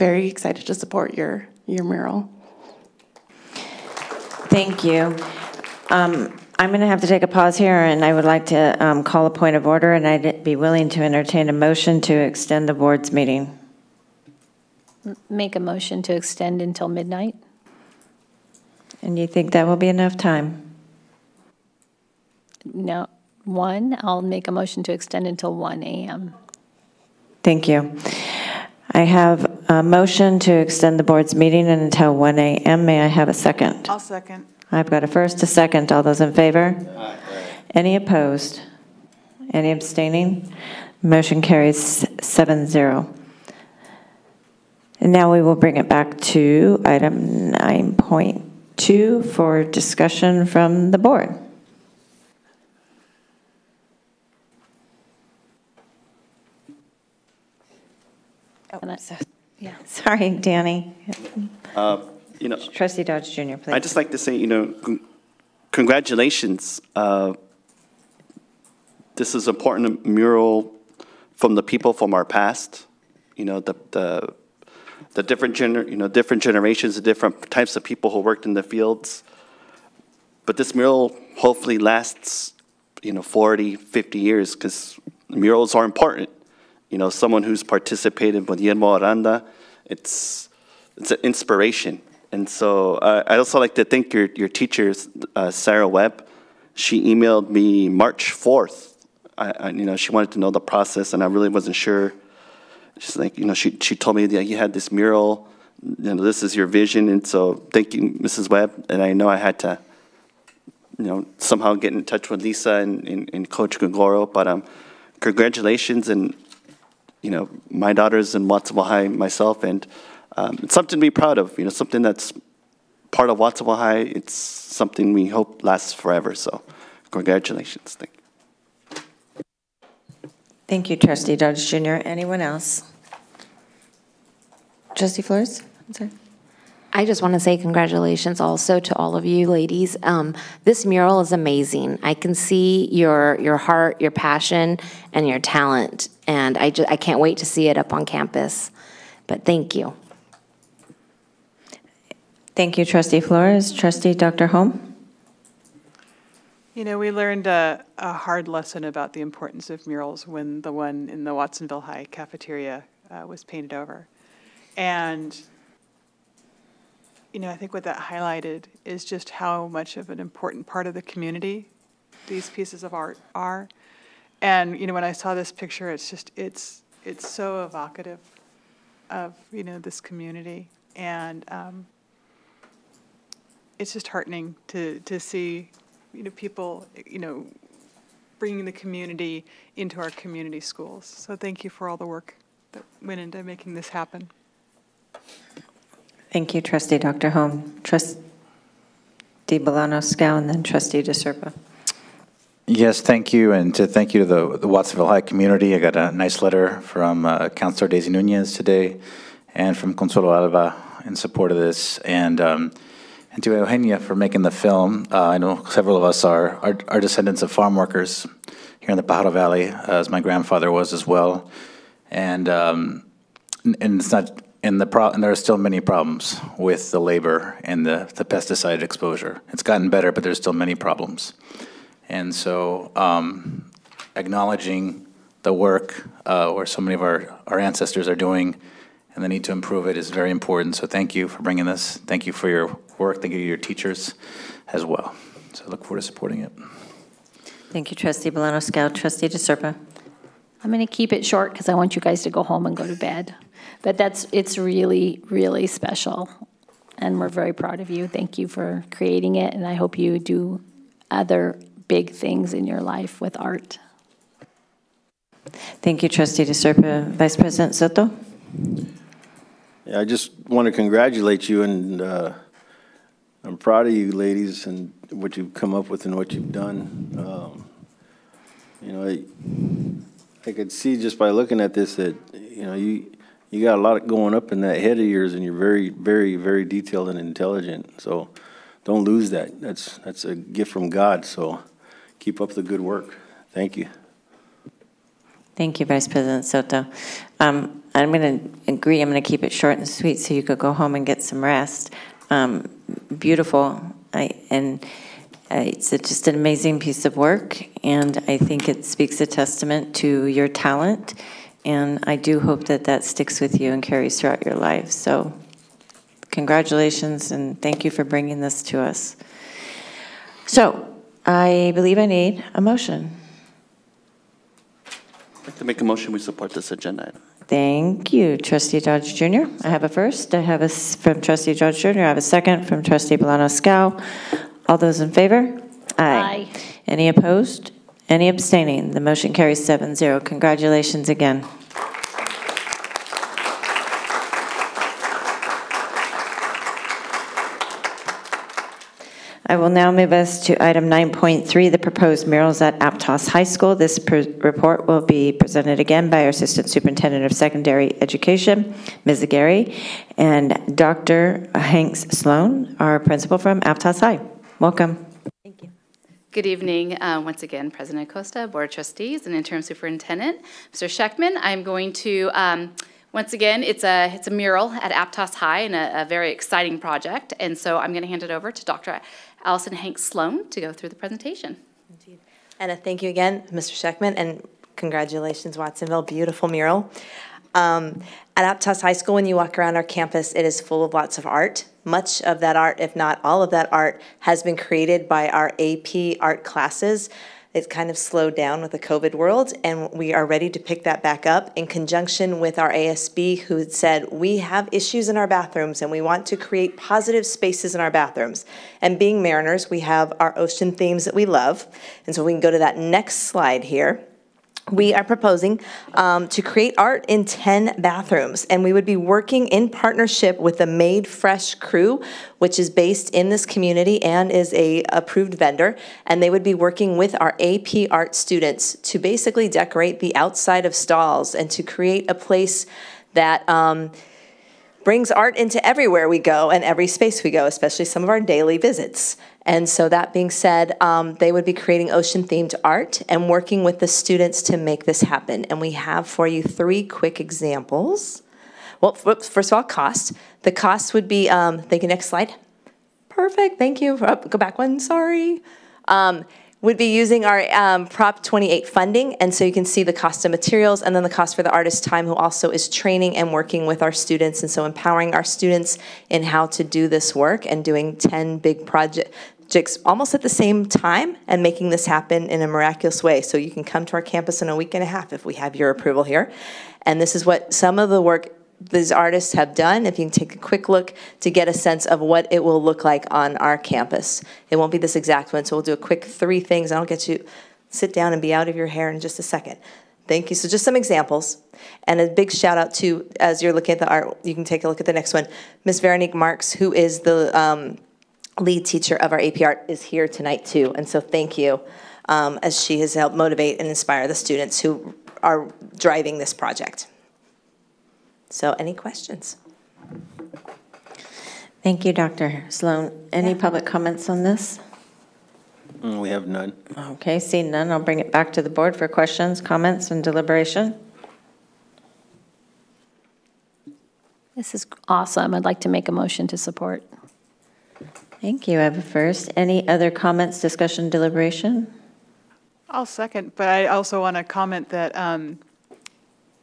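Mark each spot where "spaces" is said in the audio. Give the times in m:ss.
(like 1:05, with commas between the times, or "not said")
6:47, 7:16.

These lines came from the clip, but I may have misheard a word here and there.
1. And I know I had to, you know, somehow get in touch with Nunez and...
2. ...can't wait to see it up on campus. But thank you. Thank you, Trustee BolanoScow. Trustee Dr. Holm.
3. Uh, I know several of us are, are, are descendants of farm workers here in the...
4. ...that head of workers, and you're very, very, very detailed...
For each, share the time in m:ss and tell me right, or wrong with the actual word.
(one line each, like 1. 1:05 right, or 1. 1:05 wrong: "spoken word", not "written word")
1. 1:48 wrong: "Lisa", not "Nunez"
2. 2:26 wrong: "Flores", not "BolanoScow"
3. 3:35 right
4. 4:44 wrong: "yours", not "workers".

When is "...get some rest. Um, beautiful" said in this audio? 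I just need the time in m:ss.
5:01.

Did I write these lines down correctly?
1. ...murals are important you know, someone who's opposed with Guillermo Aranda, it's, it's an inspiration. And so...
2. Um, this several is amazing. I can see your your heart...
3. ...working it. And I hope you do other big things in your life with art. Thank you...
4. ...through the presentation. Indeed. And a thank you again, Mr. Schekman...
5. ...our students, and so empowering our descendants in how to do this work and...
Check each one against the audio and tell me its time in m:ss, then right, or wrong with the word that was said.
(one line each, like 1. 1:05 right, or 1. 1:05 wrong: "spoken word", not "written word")
1. 1:25 wrong: "participated", not "opposed"
2. 2:20 wrong: "mural", not "several"
3. 4:18 wrong: "creating", not "working"
4. 6:20 right
5. 7:43 wrong: "students", not "descendants".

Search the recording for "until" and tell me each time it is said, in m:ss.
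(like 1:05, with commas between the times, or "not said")
0:16, 0:25, 0:31.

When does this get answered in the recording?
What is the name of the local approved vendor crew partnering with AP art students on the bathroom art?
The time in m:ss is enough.
7:00.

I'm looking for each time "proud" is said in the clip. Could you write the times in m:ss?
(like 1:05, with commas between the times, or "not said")
2:01, 4:17, 4:33.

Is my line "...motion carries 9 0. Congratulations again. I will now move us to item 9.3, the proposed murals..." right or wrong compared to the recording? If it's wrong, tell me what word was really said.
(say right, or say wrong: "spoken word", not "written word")
wrong: "7", not "9".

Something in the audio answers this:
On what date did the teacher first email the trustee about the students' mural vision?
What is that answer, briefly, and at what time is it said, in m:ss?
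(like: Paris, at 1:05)
March 4th, at 1:37.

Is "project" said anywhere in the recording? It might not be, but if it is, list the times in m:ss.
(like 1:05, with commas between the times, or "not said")
6:16, 7:48, 8:26.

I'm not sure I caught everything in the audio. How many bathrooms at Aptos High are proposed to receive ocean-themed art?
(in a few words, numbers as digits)
10.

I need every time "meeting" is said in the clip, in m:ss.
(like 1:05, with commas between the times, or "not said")
0:13, 0:31.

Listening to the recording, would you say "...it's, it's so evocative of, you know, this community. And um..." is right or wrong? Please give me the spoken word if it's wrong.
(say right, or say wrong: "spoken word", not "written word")
right.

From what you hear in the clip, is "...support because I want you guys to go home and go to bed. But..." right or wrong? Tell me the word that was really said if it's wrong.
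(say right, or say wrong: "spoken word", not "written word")
wrong: "short", not "support".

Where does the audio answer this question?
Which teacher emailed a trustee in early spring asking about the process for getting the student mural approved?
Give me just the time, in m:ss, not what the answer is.
1:35.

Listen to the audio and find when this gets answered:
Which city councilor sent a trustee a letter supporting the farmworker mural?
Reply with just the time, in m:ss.
3:27.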